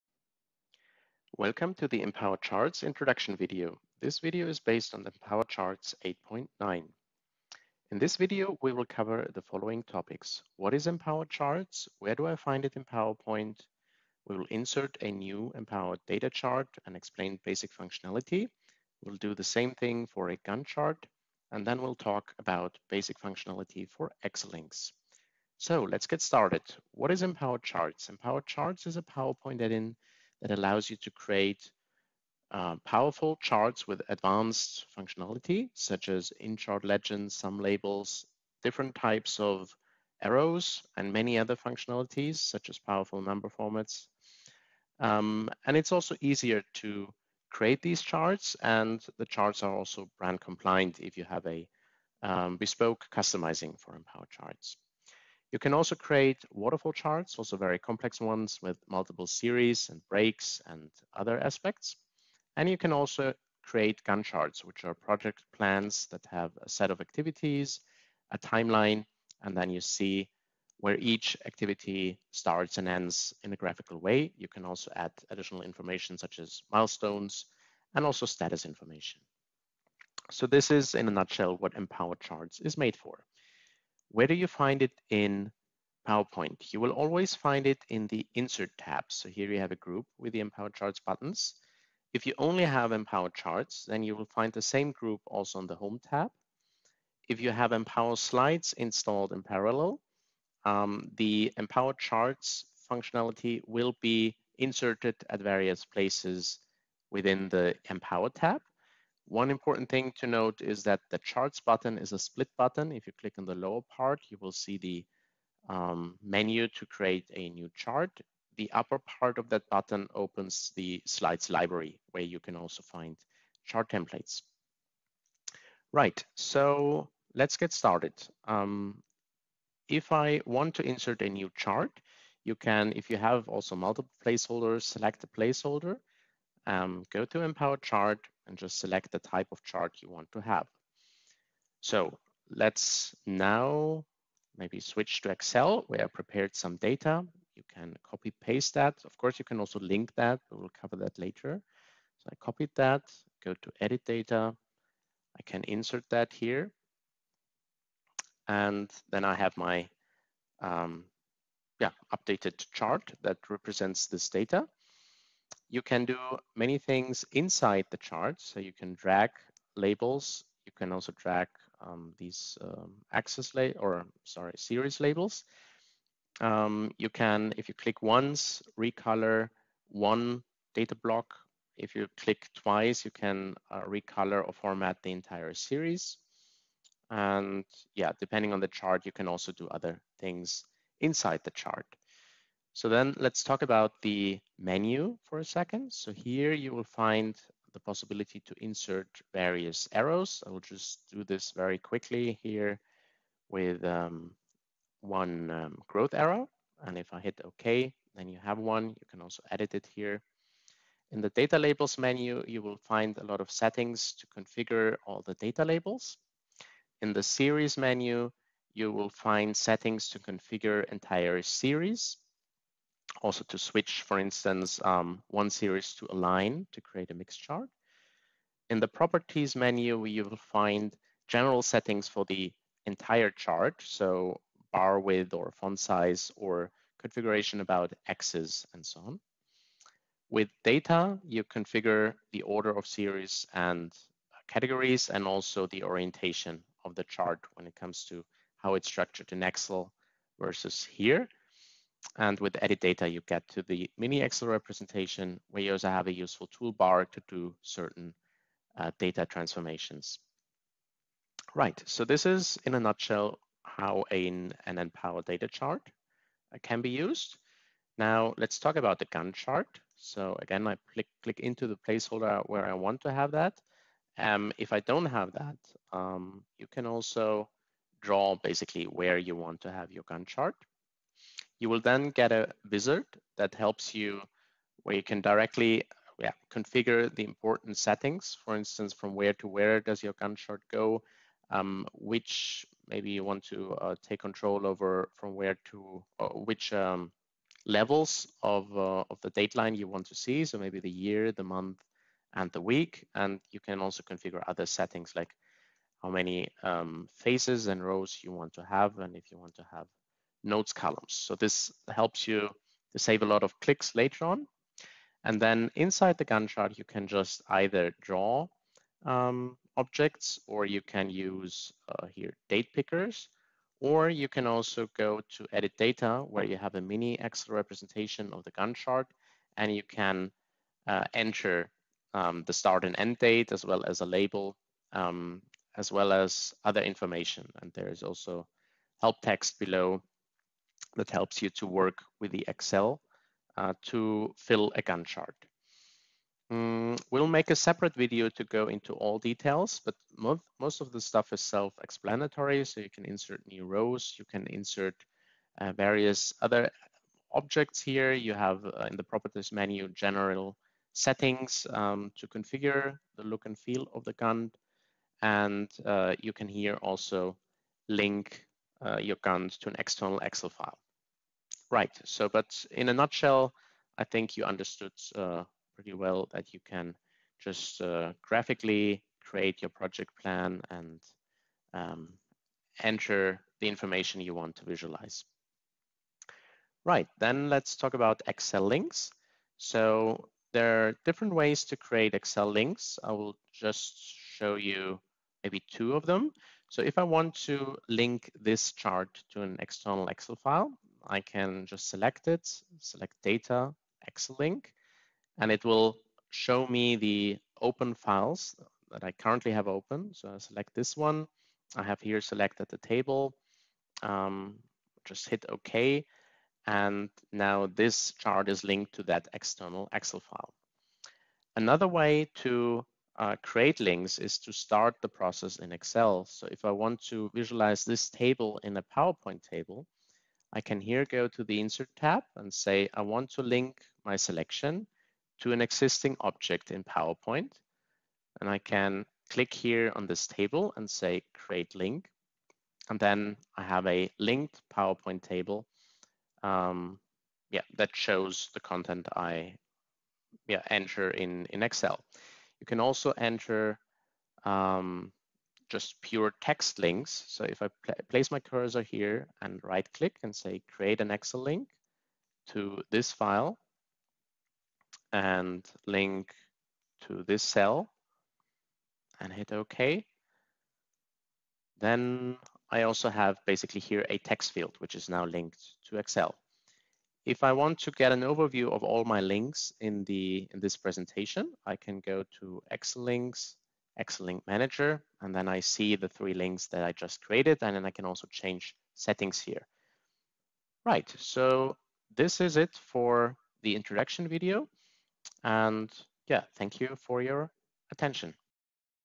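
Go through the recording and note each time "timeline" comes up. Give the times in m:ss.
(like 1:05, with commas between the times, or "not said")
1:08.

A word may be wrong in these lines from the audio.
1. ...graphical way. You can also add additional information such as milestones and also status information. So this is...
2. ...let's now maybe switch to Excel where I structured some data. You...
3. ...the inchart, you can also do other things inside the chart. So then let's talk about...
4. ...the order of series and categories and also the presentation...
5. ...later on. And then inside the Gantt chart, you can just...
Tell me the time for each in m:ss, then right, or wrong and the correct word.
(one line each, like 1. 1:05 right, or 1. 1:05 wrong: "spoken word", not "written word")
1. 1:13 right
2. 2:22 wrong: "prepared", not "structured"
3. 3:08 wrong: "chart", not "inchart"
4. 4:02 wrong: "orientation", not "presentation"
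5. 5:13 right.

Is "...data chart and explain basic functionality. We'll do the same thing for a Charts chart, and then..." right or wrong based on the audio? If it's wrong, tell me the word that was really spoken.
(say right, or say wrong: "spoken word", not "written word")
wrong: "Gantt", not "Charts".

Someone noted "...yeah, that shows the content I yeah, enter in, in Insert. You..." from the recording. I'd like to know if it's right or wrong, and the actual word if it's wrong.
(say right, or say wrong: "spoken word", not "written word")
wrong: "Excel", not "Insert".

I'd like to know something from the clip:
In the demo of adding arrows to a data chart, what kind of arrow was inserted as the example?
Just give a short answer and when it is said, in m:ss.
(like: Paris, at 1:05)
growth arrow, at 3:25.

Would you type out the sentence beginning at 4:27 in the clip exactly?
Now let's talk about the Gantt chart.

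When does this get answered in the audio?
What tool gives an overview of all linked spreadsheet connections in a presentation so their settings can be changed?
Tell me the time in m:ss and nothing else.
8:03.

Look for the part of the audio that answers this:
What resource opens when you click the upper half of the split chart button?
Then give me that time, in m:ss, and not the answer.
2:01.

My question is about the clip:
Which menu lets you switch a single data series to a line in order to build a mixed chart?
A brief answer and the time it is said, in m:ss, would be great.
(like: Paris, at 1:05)
series menu, at 3:37.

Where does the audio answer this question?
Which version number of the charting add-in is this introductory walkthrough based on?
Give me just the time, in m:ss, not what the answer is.
0:06.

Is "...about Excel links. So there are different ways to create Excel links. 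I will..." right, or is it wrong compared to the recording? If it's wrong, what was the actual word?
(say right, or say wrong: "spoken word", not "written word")
right.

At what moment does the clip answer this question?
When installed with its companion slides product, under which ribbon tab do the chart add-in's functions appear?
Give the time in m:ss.
1:47.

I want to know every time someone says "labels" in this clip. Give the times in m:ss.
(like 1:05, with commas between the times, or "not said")
0:37, 2:49, 2:54, 3:31, 3:35, 5:34.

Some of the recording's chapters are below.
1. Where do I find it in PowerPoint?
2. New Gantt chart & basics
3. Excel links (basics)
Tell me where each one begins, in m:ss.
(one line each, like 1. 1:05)
1. 1:24
2. 4:27
3. 6:26.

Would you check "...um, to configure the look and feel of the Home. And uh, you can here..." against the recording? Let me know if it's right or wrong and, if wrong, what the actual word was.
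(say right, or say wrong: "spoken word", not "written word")
wrong: "Gantt", not "Home".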